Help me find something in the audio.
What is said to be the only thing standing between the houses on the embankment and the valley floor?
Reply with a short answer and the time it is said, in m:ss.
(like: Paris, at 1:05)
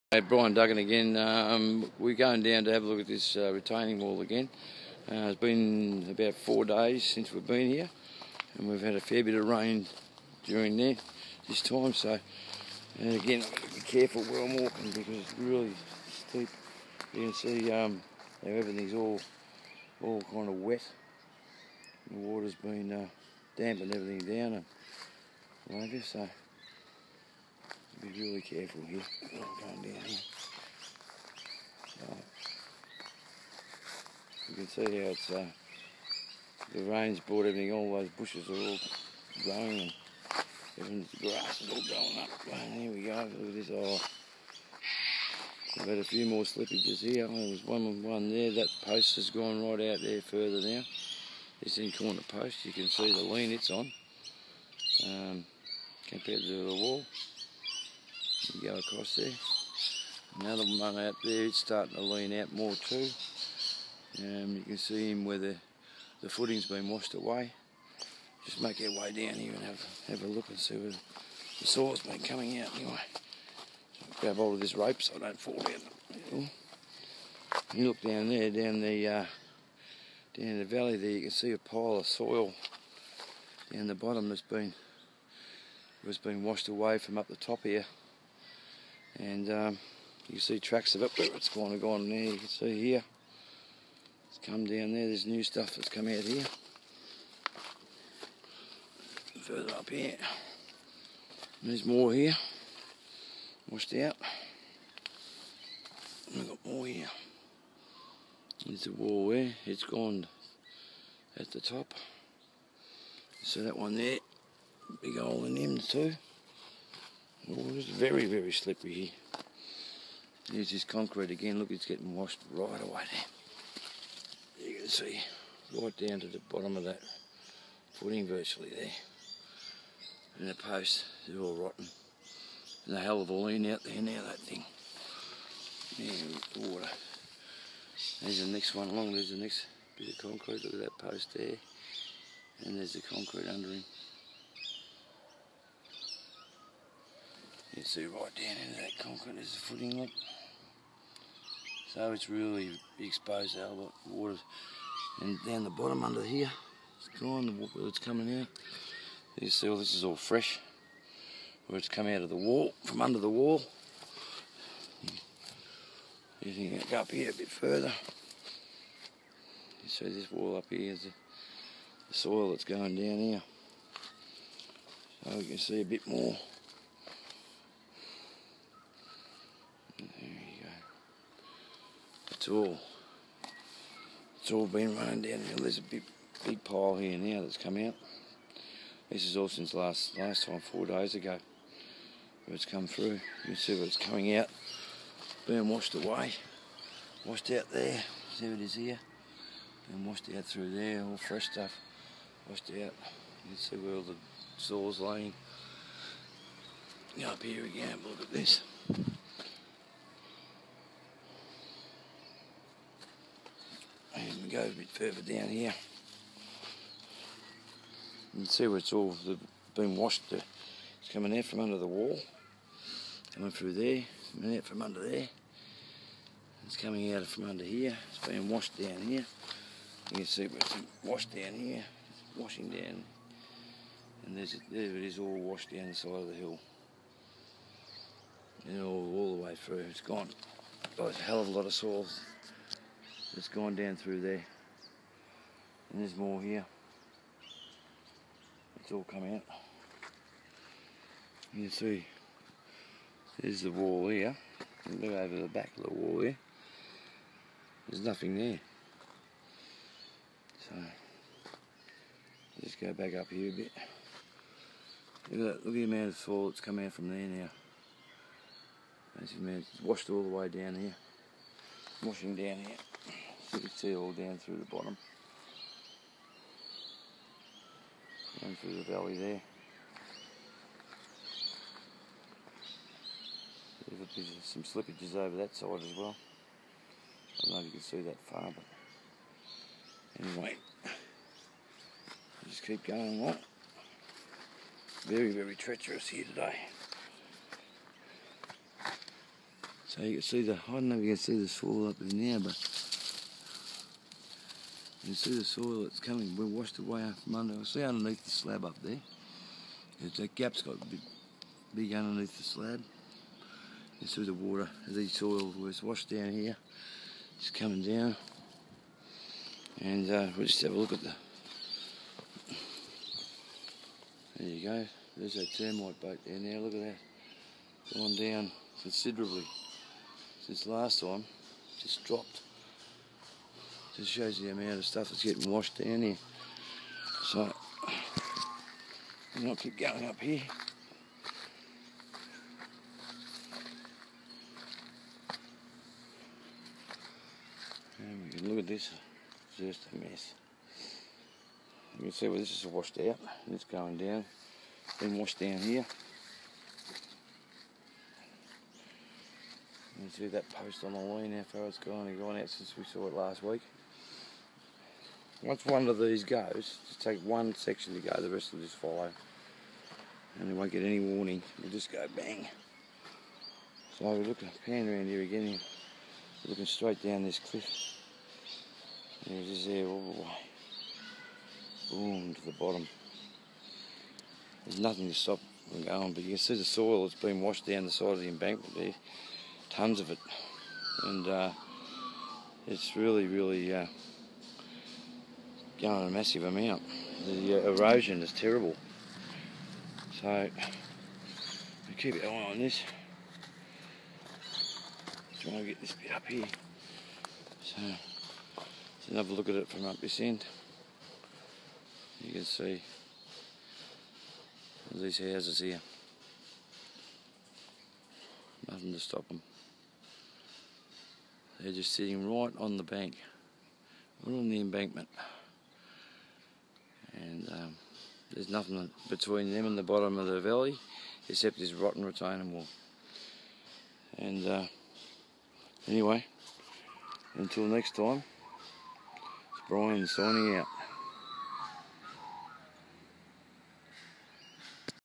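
Rotten retaining wall, at 7:11.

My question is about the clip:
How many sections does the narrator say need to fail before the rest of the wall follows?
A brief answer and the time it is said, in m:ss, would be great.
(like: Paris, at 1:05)
1, at 6:07.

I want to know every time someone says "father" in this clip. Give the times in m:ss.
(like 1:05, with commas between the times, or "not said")
not said.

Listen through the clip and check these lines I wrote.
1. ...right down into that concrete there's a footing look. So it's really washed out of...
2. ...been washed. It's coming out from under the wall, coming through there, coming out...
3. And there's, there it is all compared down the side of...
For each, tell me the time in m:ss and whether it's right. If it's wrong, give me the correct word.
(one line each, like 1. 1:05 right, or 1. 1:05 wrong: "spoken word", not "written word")
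1. 2:28 wrong: "exposed", not "washed"
2. 3:39 right
3. 3:54 wrong: "washed", not "compared".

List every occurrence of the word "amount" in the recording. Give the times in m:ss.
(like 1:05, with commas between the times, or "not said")
4:25, 5:34, 6:36.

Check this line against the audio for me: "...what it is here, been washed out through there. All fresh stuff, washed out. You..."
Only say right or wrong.
right.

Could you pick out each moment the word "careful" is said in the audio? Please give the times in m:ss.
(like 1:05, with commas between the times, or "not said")
0:13, 0:28.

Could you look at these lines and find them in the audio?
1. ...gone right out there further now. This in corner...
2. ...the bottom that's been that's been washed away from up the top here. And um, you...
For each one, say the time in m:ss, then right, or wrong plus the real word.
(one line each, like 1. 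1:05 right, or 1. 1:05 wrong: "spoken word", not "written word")
1. 0:49 right
2. 1:23 right.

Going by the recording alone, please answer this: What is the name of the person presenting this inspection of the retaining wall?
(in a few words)
Brian Duggan.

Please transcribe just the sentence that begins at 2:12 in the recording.
And a hell of a lean out there now, that thing.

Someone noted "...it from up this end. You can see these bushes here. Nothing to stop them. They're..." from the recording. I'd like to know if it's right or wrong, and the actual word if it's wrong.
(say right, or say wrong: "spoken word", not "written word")
wrong: "houses", not "bushes".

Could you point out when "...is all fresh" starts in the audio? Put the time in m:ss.
2:39.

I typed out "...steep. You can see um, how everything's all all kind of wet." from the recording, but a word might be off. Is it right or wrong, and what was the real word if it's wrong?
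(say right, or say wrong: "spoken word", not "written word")
right.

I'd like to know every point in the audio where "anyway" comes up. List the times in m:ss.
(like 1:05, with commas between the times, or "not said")
1:12, 4:50, 7:15.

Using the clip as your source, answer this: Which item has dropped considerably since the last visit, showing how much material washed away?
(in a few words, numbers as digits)
Termite boat.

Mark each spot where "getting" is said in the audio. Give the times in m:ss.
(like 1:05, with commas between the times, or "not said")
2:01, 5:35.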